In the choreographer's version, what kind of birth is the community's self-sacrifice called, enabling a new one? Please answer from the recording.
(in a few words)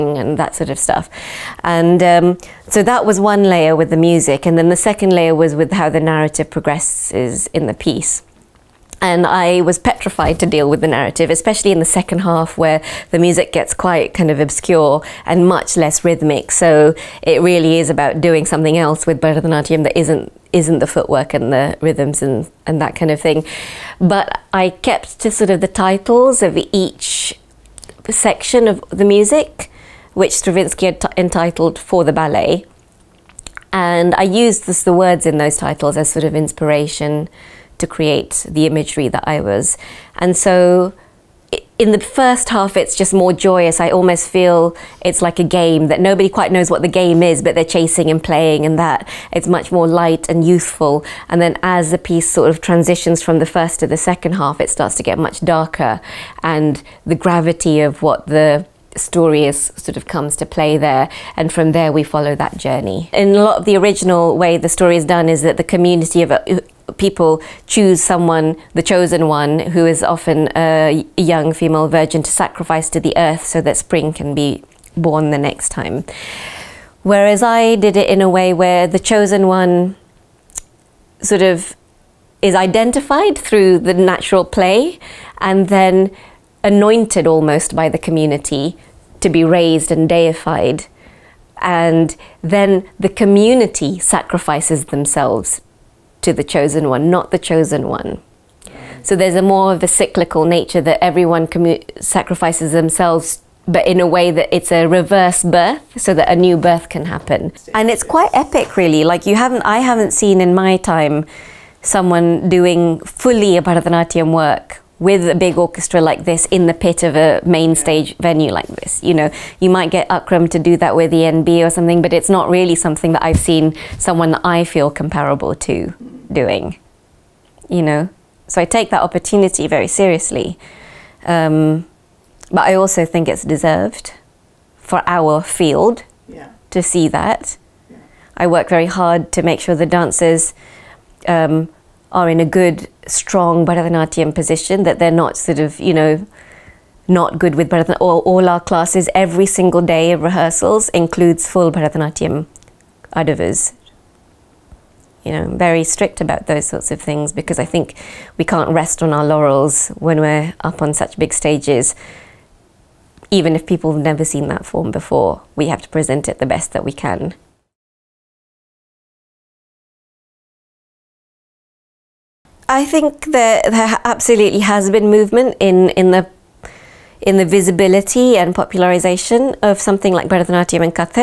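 reverse birth.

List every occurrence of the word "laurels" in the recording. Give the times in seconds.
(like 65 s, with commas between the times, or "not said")
159 s.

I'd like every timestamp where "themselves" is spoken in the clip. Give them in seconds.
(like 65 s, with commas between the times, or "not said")
94 s, 102 s.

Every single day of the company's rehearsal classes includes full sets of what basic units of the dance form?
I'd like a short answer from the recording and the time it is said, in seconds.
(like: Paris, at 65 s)
Bharatanatyam adavus, at 151 s.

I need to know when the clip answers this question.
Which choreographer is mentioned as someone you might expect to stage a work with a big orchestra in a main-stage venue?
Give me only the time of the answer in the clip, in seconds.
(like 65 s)
120 s.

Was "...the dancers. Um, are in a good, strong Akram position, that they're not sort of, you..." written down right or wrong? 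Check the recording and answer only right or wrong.
wrong.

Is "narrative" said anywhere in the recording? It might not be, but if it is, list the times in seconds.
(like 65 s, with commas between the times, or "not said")
6 s, 10 s.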